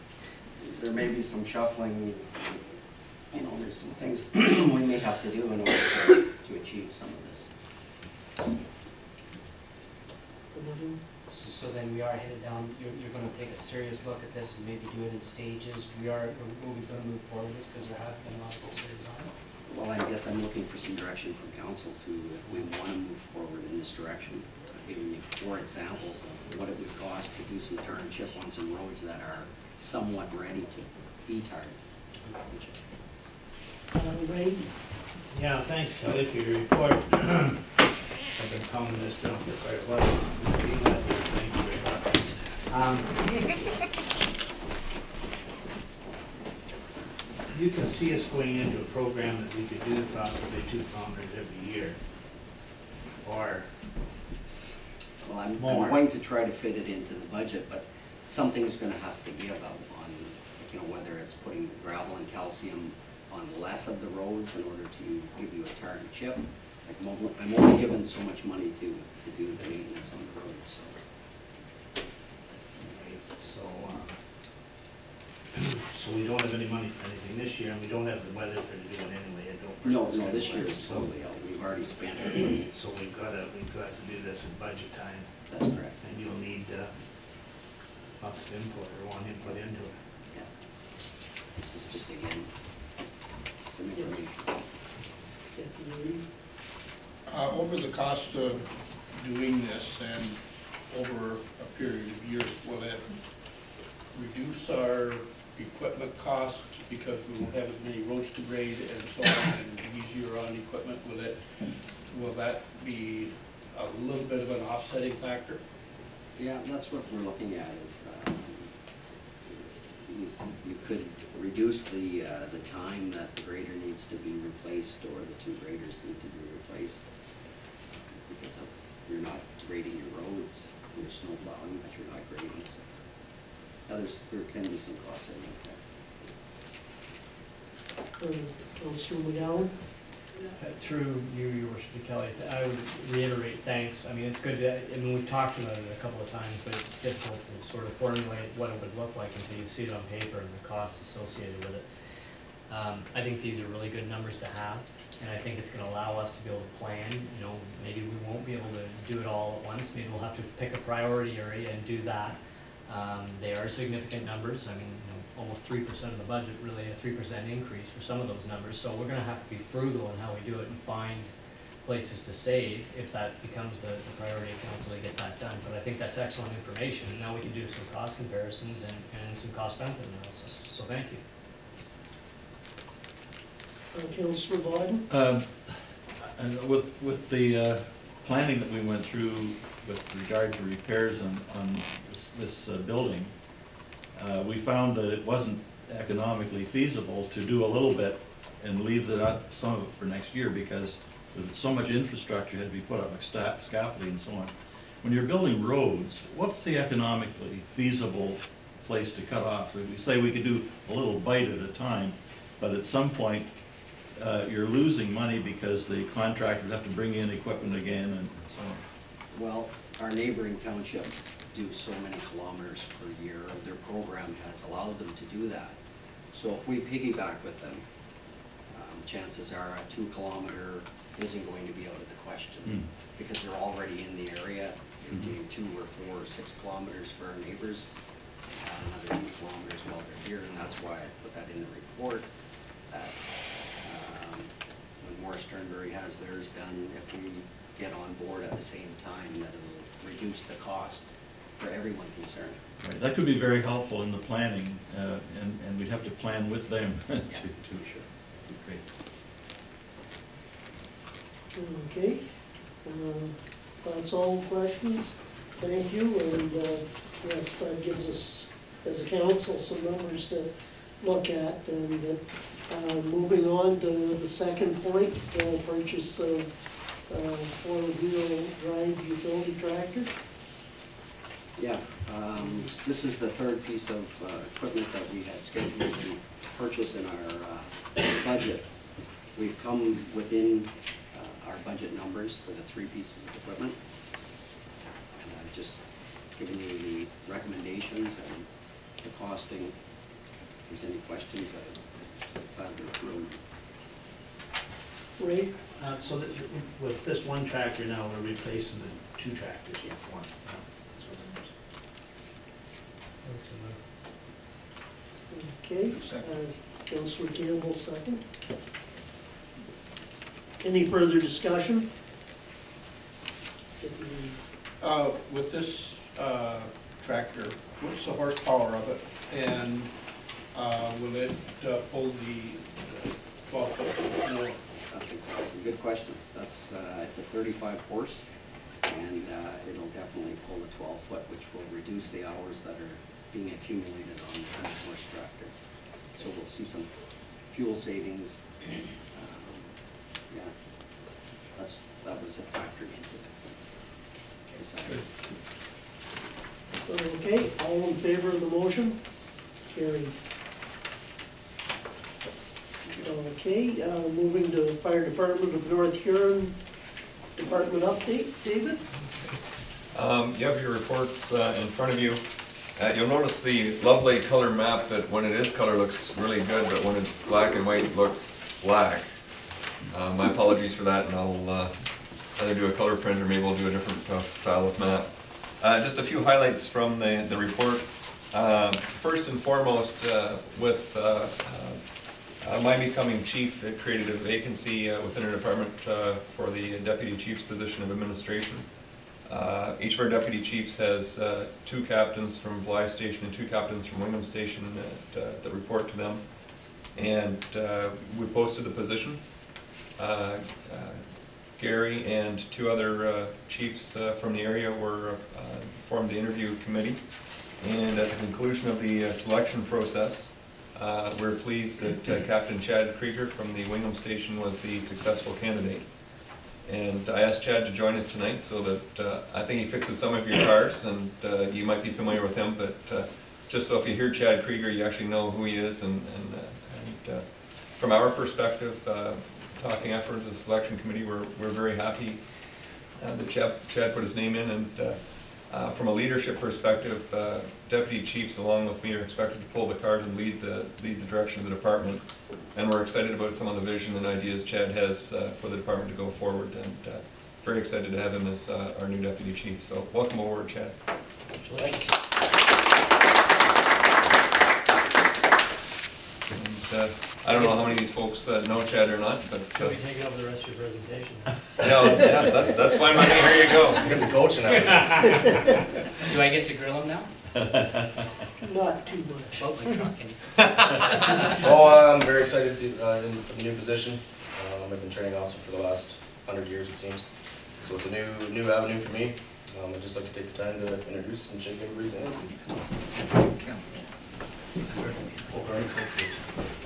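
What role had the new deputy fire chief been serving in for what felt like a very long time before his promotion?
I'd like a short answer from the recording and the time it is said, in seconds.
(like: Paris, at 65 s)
Training officer, at 484 s.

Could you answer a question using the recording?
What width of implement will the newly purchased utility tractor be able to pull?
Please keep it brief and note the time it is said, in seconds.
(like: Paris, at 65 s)
12 foot, at 340 s.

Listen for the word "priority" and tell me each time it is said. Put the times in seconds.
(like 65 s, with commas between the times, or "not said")
160 s, 174 s.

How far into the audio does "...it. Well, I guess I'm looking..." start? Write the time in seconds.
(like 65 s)
19 s.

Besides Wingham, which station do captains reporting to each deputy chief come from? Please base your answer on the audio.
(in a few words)
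Blyth.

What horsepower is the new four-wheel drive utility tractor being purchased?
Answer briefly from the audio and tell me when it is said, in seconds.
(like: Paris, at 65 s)
35, at 337 s.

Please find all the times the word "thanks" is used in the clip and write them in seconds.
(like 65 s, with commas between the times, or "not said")
35 s, 143 s, 180 s, 265 s, 461 s.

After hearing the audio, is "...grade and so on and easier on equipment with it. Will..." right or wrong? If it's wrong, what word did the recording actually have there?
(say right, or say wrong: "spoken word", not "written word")
right.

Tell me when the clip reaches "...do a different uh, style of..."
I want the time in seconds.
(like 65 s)
383 s.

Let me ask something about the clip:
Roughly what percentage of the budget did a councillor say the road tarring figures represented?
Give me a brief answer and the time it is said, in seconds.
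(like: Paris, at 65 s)
3%, at 165 s.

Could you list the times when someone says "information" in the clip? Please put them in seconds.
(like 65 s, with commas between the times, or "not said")
93 s, 176 s.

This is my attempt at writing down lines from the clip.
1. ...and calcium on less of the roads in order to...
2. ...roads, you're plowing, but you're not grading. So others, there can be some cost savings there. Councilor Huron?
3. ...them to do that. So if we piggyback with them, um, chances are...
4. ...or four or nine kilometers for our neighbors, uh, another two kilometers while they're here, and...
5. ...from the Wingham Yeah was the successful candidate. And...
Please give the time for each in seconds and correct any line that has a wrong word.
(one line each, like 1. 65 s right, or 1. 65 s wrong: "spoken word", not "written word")
1. 62 s right
2. 130 s wrong: "McGowan", not "Huron"
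3. 224 s right
4. 235 s wrong: "six", not "nine"
5. 423 s wrong: "Station", not "Yeah".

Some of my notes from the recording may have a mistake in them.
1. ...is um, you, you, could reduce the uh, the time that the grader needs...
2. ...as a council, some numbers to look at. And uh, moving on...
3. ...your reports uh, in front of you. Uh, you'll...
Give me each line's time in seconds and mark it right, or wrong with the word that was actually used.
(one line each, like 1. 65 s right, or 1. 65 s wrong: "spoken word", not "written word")
1. 117 s right
2. 268 s right
3. 370 s right.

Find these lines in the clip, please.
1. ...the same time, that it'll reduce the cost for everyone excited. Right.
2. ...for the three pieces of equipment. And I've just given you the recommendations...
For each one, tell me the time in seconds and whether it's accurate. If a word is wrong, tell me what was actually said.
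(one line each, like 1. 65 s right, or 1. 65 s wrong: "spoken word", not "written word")
1. 248 s wrong: "concerned", not "excited"
2. 292 s right.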